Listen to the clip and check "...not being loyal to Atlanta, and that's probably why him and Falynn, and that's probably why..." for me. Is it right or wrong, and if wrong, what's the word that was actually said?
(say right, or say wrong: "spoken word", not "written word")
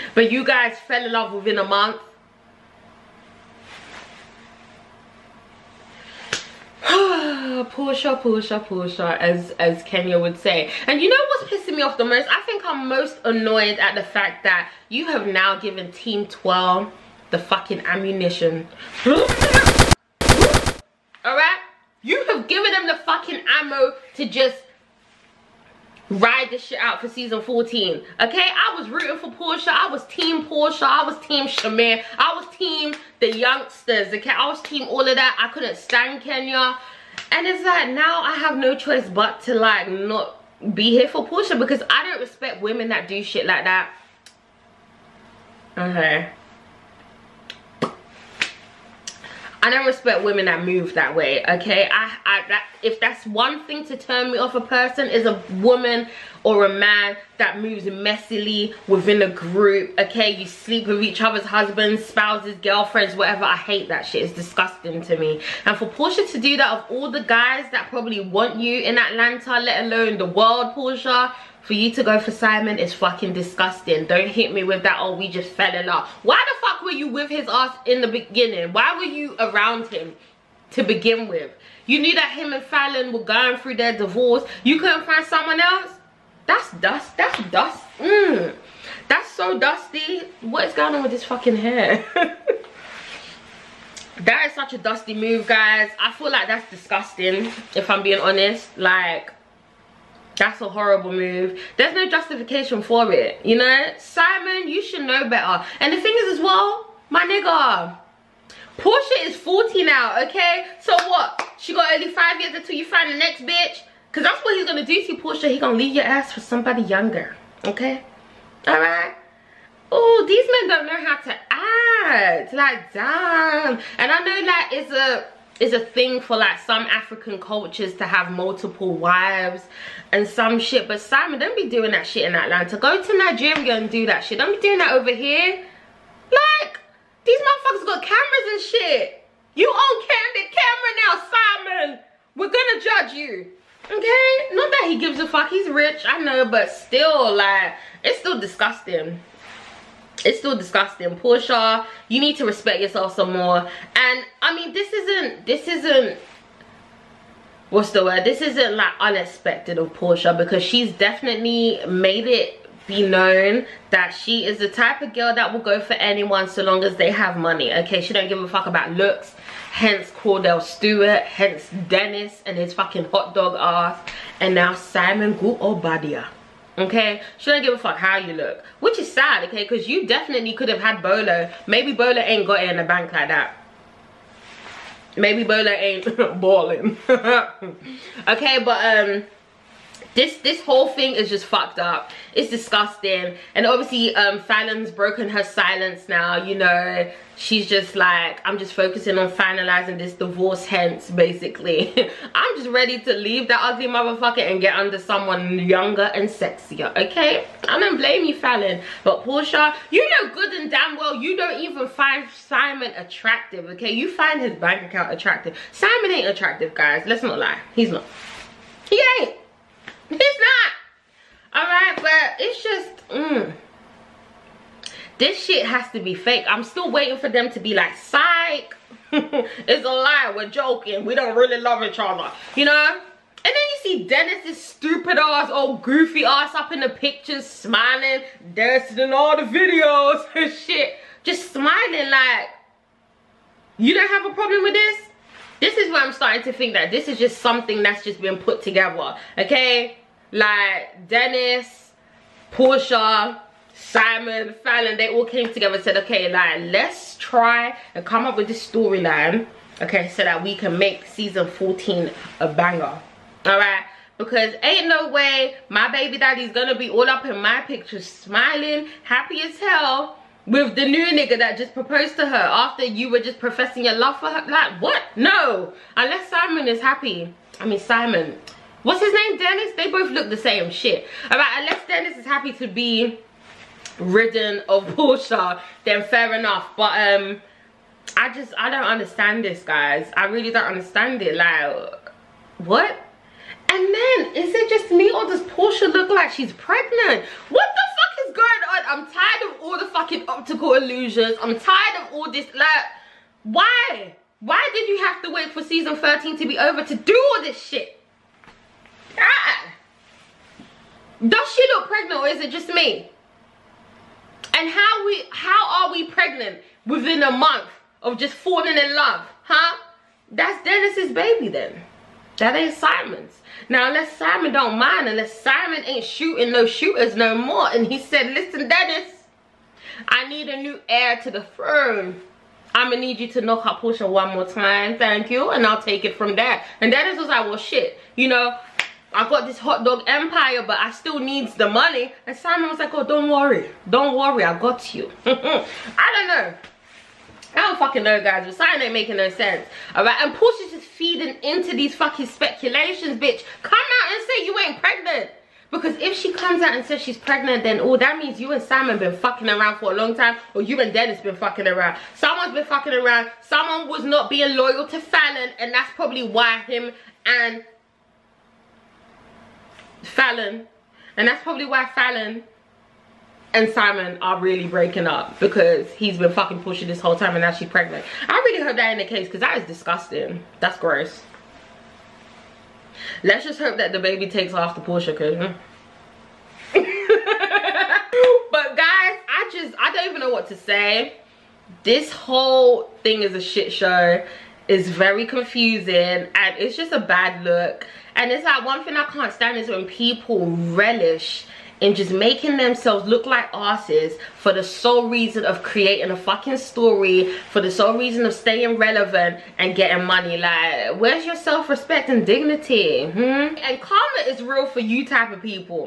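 wrong: "Falynn", not "Atlanta".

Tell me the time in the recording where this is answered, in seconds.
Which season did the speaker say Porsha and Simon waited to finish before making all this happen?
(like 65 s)
305 s.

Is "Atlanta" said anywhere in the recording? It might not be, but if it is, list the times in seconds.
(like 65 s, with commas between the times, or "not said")
68 s, 132 s.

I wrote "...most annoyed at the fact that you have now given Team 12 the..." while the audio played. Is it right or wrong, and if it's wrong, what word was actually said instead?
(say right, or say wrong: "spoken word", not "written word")
right.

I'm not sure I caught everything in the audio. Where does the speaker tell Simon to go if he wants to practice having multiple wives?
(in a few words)
Nigeria.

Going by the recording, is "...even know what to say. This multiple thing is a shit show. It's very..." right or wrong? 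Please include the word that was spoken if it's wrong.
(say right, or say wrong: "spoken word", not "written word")
wrong: "whole", not "multiple".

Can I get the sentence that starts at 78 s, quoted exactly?
Why were you around him to begin with?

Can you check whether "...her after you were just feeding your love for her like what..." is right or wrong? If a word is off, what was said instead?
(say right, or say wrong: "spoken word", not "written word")
wrong: "professing", not "feeding".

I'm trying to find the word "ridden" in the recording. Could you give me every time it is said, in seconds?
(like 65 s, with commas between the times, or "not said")
283 s.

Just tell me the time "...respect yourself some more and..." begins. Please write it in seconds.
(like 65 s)
152 s.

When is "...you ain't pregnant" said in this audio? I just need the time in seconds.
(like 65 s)
354 s.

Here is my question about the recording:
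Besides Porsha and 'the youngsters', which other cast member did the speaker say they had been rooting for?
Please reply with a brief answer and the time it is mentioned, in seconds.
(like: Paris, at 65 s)
Shamir, at 31 s.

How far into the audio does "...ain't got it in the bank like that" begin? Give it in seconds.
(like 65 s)
182 s.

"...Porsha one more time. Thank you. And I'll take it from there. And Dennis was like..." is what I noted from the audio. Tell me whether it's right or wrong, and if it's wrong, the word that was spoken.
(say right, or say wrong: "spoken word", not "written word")
right.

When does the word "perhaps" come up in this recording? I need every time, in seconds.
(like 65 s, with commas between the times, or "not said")
not said.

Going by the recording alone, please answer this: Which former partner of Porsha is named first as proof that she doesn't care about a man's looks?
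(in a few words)
Cordell Stewart.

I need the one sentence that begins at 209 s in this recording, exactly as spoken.
But Porsha, you know good and damn well you don't even find Simon attractive, okay?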